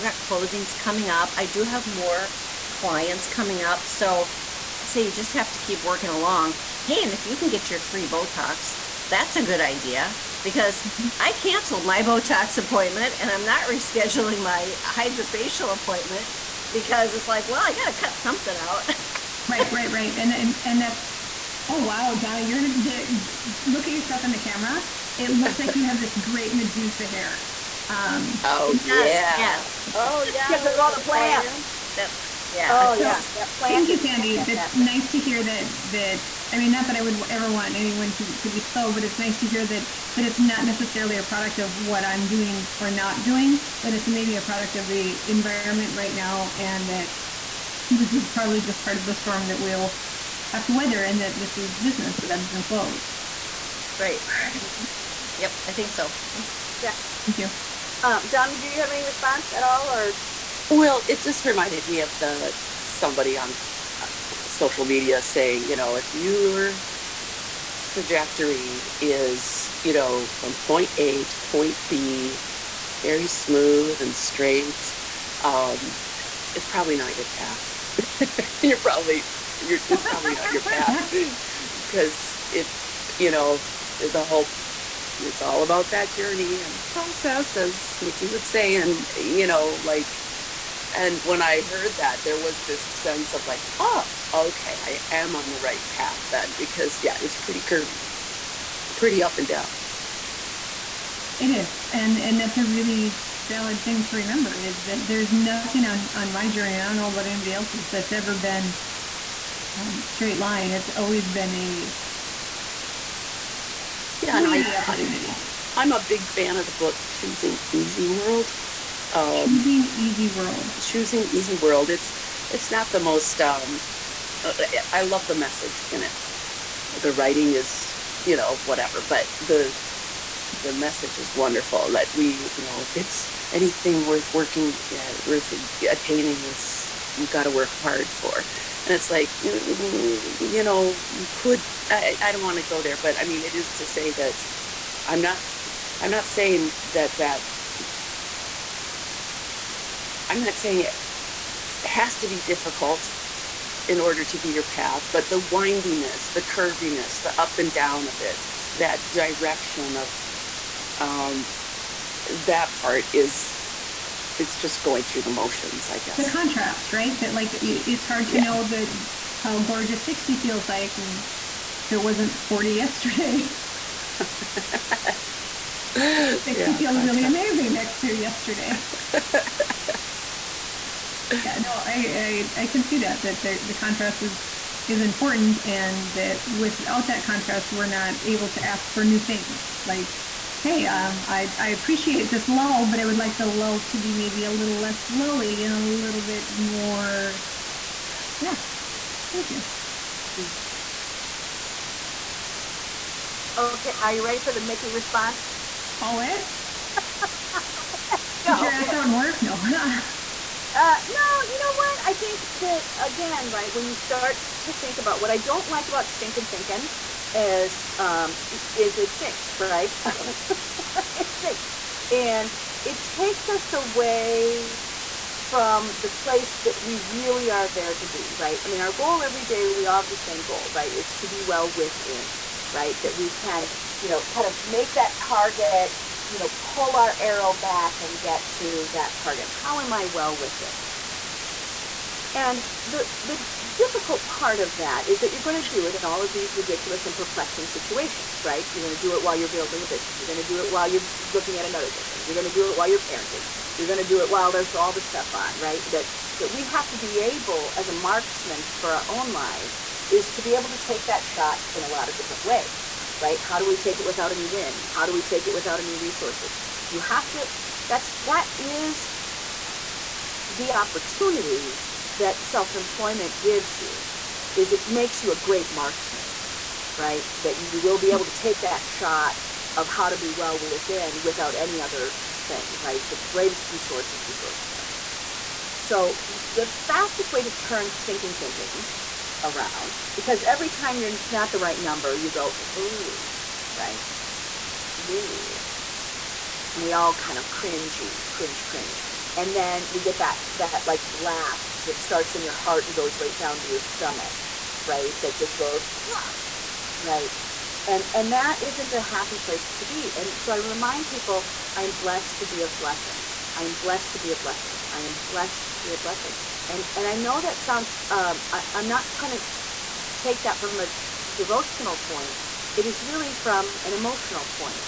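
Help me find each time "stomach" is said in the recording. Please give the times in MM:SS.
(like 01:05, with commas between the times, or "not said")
05:03.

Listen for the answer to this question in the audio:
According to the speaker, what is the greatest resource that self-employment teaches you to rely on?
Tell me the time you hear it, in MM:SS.
04:44.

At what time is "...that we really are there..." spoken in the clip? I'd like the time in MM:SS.
03:46.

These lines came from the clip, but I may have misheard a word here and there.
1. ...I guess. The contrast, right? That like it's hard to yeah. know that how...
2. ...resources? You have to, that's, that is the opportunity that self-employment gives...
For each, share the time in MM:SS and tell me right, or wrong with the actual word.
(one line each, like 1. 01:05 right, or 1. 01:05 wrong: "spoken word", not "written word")
1. 02:45 right
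2. 04:25 right.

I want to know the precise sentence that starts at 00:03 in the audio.
So I say you just have to keep working along.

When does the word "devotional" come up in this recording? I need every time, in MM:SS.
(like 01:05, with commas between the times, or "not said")
05:21.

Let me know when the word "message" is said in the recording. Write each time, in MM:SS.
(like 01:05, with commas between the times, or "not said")
02:05, 02:10.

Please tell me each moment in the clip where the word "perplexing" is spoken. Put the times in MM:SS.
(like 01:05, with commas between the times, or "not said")
04:07.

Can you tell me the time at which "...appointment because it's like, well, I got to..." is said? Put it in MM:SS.
00:15.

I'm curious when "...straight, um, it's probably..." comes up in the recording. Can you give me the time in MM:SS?
01:14.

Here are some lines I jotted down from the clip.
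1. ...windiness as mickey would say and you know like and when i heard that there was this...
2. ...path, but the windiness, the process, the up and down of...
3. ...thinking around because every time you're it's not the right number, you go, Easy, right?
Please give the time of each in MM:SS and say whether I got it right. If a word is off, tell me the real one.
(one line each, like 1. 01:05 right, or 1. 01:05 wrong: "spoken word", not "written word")
1. 01:26 wrong: "process", not "windiness"
2. 02:34 wrong: "curviness", not "process"
3. 04:48 wrong: "Ooh", not "Easy".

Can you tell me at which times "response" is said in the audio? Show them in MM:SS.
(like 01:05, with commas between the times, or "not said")
00:59, 03:24.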